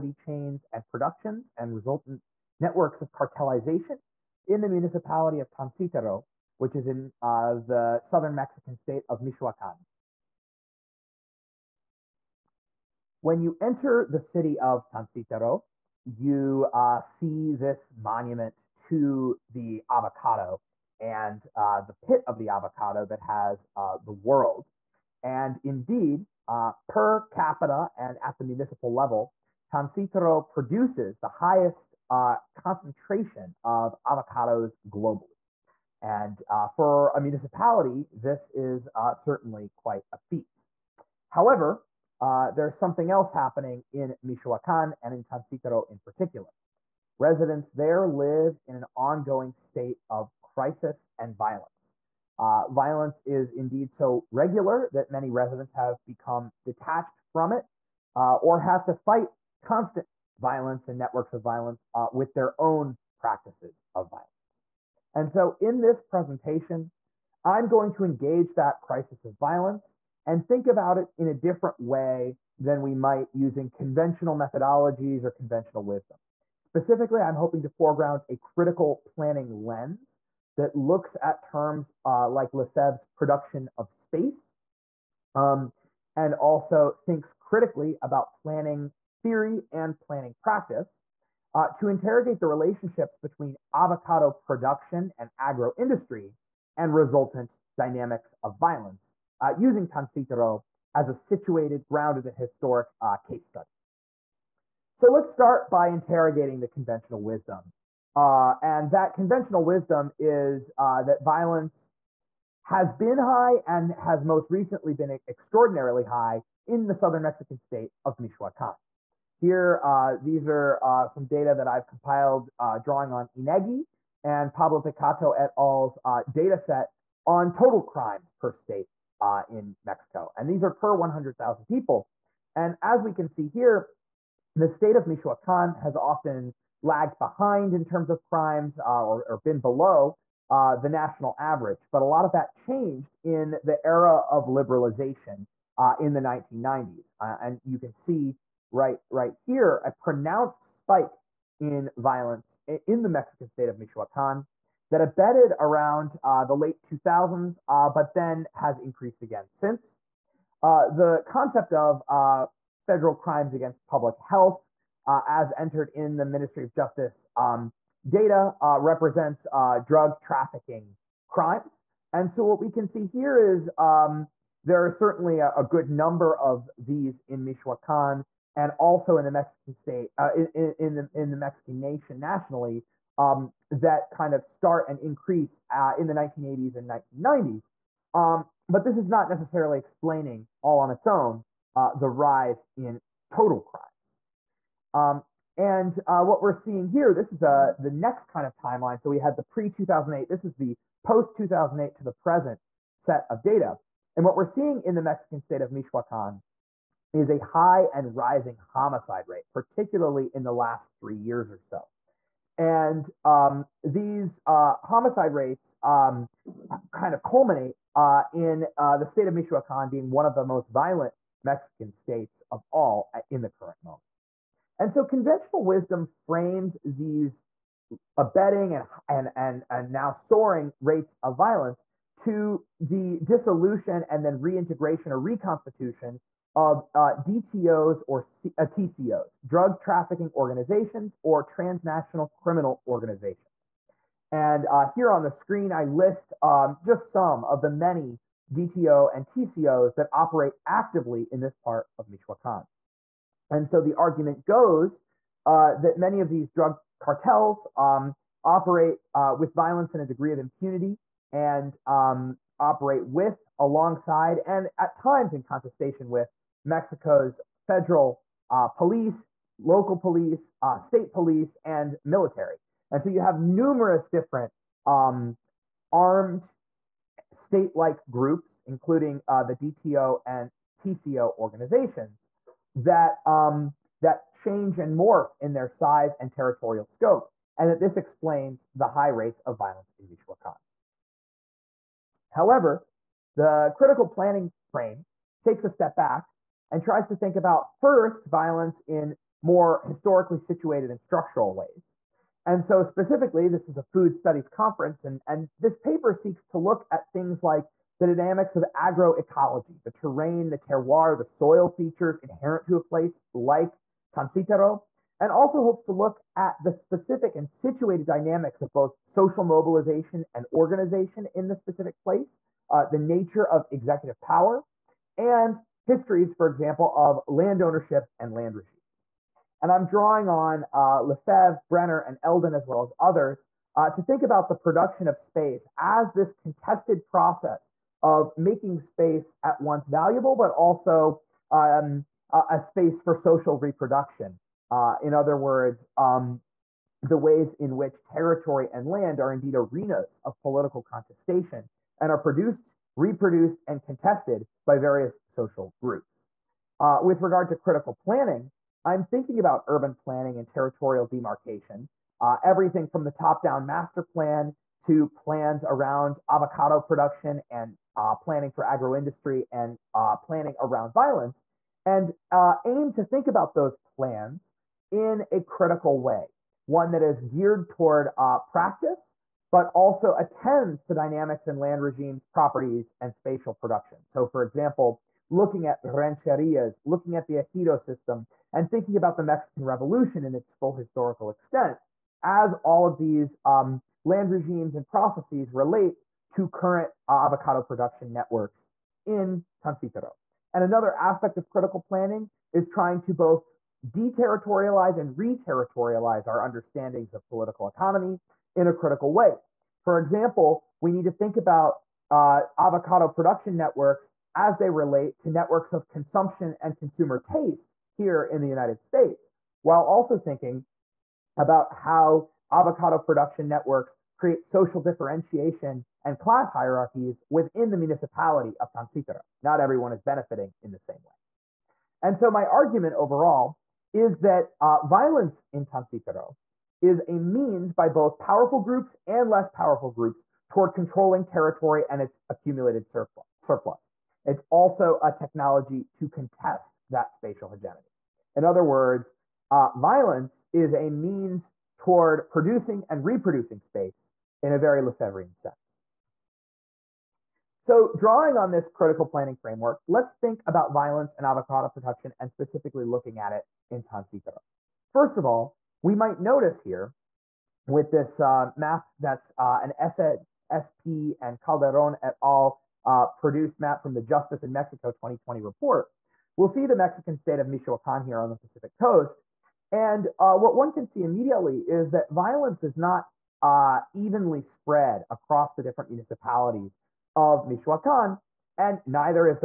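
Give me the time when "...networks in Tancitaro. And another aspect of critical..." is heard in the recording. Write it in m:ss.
6:38.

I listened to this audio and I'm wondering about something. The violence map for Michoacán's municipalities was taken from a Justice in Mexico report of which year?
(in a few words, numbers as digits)
2020.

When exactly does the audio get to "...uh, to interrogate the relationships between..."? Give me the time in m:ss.
1:31.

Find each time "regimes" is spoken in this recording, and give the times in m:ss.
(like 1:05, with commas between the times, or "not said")
5:28, 6:21, 6:34.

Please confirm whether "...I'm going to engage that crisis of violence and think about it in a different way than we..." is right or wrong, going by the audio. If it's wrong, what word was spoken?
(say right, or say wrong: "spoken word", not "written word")
right.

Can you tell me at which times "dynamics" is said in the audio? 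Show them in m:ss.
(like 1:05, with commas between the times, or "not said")
1:37, 5:08, 5:18, 6:20.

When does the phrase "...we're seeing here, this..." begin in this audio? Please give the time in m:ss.
3:16.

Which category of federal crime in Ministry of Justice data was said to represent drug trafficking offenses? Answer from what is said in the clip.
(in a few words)
Crimes against public health.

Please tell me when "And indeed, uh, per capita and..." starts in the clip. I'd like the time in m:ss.
0:25.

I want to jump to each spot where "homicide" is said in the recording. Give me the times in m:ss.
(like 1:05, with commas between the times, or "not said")
3:28, 3:34.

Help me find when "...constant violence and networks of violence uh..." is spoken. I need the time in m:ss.
0:59.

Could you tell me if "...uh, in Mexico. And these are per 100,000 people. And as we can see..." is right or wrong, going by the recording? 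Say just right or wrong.
right.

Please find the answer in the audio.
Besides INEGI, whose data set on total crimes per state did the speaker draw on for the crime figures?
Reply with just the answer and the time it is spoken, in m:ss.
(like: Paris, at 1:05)
Pablo Piccato et al., at 2:04.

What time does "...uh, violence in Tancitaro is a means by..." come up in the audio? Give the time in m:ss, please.
7:14.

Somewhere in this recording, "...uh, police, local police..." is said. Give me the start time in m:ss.
4:28.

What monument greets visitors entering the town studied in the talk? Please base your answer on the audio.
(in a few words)
Monument to the avocado.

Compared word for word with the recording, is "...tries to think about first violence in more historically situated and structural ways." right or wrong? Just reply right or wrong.
right.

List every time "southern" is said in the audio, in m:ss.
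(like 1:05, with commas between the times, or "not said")
0:08, 1:56.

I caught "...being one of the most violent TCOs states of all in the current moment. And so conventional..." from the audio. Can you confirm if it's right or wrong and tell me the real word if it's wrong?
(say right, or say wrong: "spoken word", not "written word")
wrong: "Mexican", not "TCOs".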